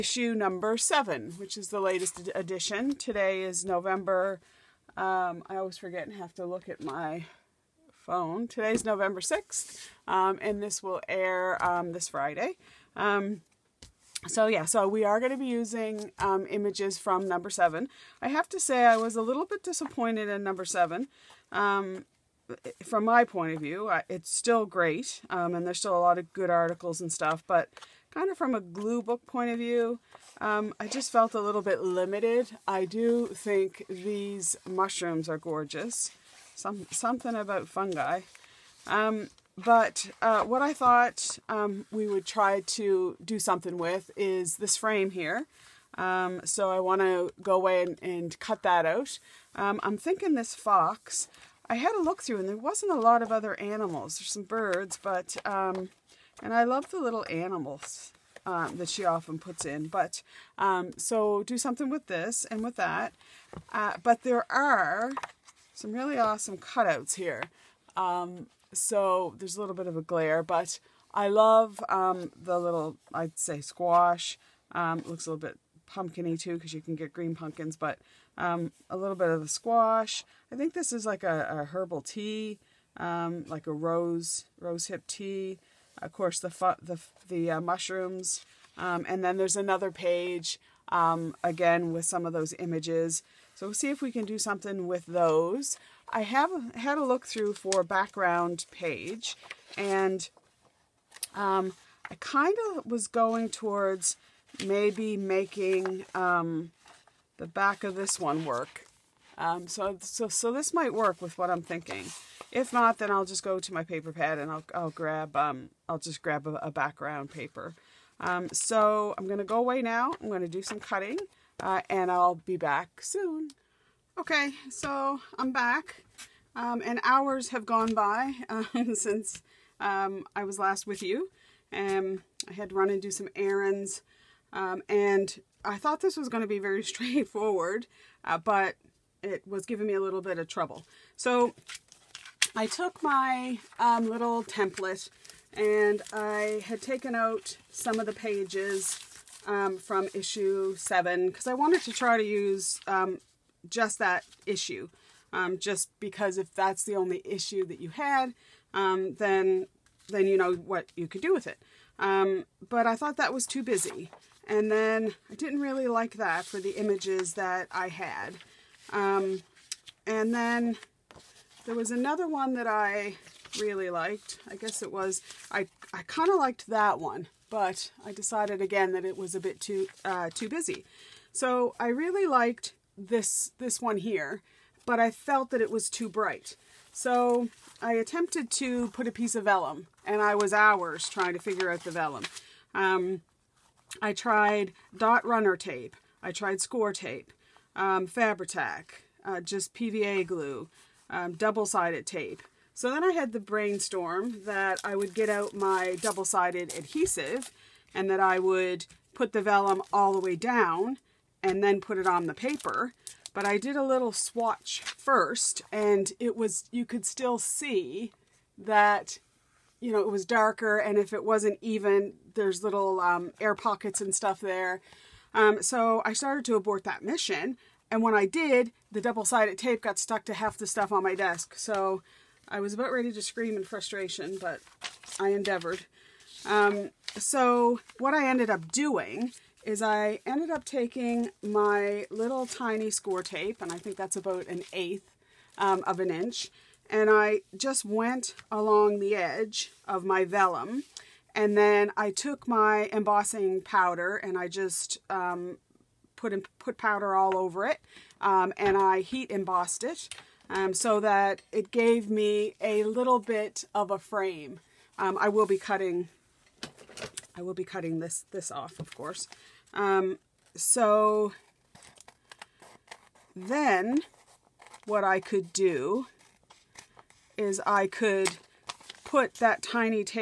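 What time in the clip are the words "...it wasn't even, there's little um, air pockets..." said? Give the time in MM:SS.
03:41.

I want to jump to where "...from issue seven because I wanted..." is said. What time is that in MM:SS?
02:29.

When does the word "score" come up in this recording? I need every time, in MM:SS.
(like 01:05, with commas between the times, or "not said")
03:16, 04:02.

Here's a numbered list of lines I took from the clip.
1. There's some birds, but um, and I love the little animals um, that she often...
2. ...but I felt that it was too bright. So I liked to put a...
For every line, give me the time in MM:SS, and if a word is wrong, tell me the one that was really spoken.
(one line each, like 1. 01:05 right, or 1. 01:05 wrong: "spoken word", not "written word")
1. 00:54 right
2. 03:04 wrong: "attempted", not "liked".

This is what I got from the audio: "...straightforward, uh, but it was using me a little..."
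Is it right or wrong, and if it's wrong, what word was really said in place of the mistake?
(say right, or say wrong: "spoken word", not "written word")
wrong: "giving", not "using".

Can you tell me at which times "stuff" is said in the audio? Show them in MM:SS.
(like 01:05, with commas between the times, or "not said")
00:27, 03:44, 03:50.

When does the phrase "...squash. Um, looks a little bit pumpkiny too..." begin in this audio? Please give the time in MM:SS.
01:13.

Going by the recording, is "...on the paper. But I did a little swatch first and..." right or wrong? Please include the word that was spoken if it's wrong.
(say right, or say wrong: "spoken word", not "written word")
right.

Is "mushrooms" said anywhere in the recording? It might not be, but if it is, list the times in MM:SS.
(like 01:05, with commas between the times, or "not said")
00:34, 01:27.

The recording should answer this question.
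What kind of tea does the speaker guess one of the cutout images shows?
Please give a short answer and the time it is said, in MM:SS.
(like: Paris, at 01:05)
rose hip tea, at 01:23.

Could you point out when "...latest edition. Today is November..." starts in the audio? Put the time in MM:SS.
00:01.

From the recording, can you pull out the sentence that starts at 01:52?
If not, then I'll just go to my paper pad and I'll, I'll grab, um, I'll just grab a, a background paper.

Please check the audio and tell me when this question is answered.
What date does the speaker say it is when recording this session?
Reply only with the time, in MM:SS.
00:08.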